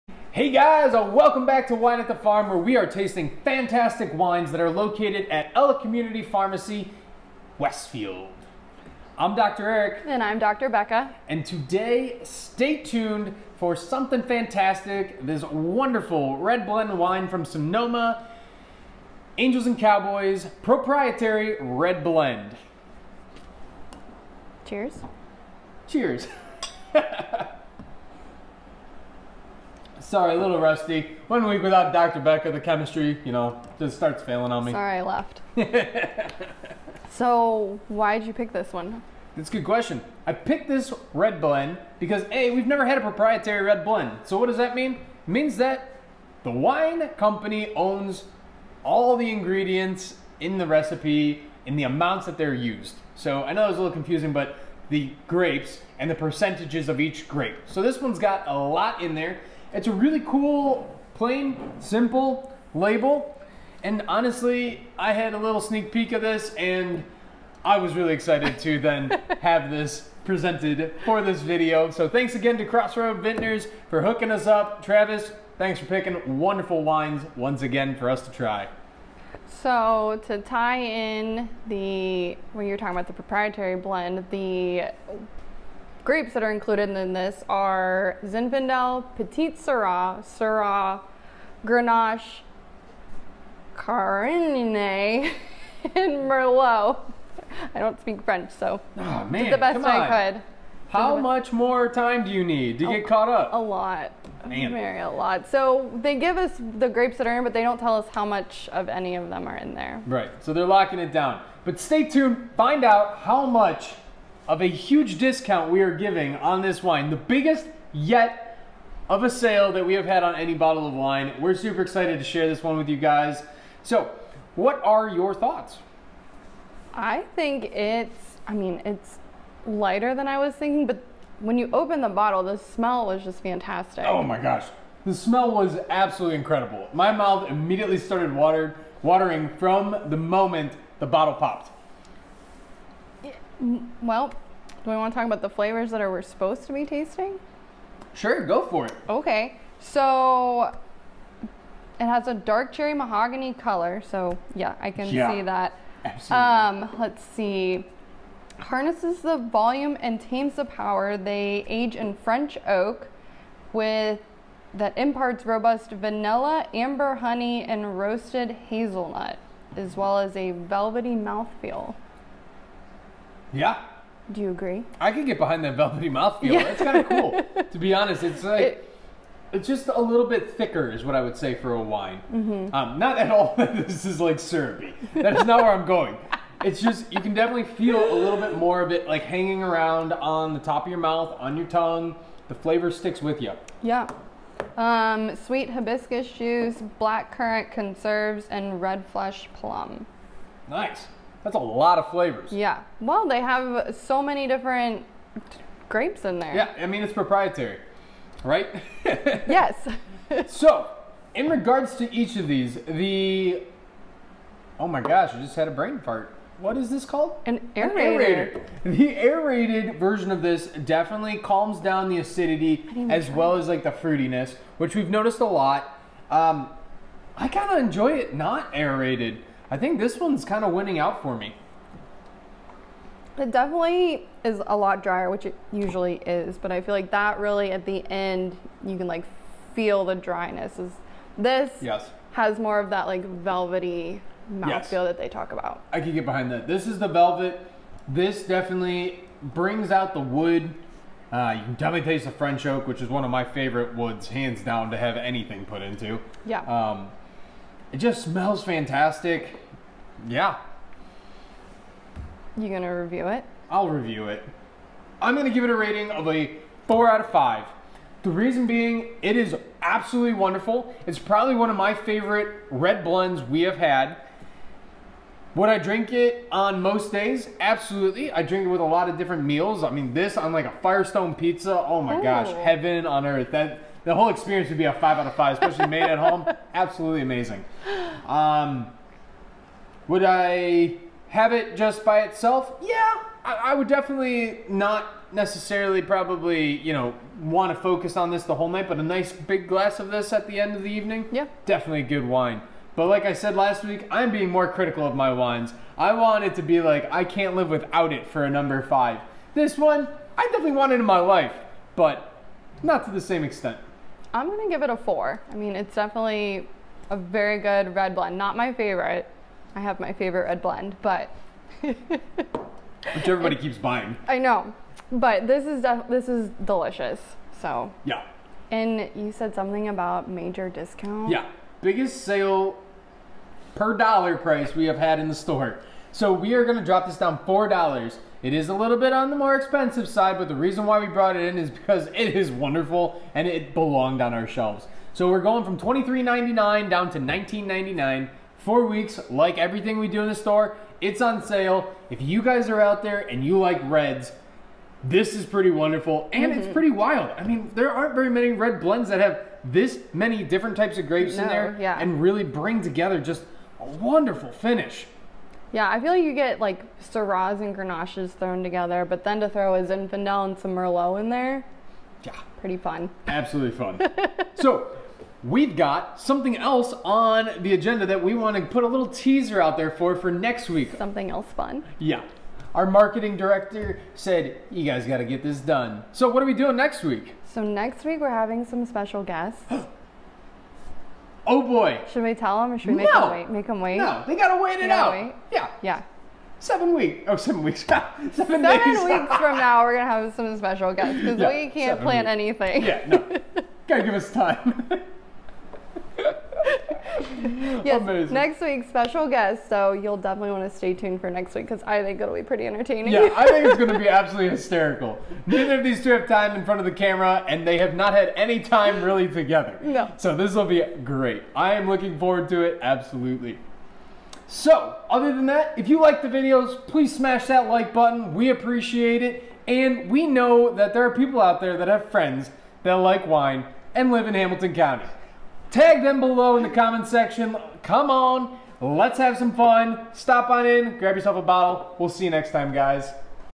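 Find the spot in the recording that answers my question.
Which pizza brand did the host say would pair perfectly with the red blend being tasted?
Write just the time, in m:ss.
4:40.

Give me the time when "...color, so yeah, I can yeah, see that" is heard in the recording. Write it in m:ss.
2:33.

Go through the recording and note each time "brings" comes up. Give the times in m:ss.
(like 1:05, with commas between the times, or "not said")
4:09, 6:02.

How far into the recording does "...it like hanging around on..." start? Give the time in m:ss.
3:08.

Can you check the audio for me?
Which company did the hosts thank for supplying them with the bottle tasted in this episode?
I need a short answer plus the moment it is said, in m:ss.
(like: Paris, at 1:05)
Crossroad Vintners, at 1:12.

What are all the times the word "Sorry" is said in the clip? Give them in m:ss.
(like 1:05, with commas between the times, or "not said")
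0:30, 0:34.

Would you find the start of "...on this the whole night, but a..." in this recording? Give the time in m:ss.
4:58.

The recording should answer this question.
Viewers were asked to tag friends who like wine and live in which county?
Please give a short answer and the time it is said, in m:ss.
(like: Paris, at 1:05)
Hamilton County, at 7:14.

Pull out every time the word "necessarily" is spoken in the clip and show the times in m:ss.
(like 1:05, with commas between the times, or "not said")
4:55.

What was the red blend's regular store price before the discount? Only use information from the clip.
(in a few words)
$23.99.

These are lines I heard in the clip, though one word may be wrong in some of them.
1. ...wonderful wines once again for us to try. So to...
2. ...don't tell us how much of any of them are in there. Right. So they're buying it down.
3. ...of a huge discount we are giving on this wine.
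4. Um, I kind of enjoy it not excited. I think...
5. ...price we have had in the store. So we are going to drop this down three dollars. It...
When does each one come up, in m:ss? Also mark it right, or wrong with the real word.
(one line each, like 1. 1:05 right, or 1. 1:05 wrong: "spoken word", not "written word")
1. 1:16 right
2. 1:47 wrong: "locking", not "buying"
3. 1:54 right
4. 3:46 wrong: "aerated", not "excited"
5. 5:34 wrong: "four", not "three".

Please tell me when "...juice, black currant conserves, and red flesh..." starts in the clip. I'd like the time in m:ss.
3:16.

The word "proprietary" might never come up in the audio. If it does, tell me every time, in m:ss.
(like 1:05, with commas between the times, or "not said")
0:20, 0:43, 1:23, 3:27.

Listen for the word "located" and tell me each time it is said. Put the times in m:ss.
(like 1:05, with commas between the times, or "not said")
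0:04.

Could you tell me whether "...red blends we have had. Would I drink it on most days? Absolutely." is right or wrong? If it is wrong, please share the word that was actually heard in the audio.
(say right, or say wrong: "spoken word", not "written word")
right.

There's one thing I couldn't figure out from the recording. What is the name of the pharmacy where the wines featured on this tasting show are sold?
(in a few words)
Ella Community Pharmacy.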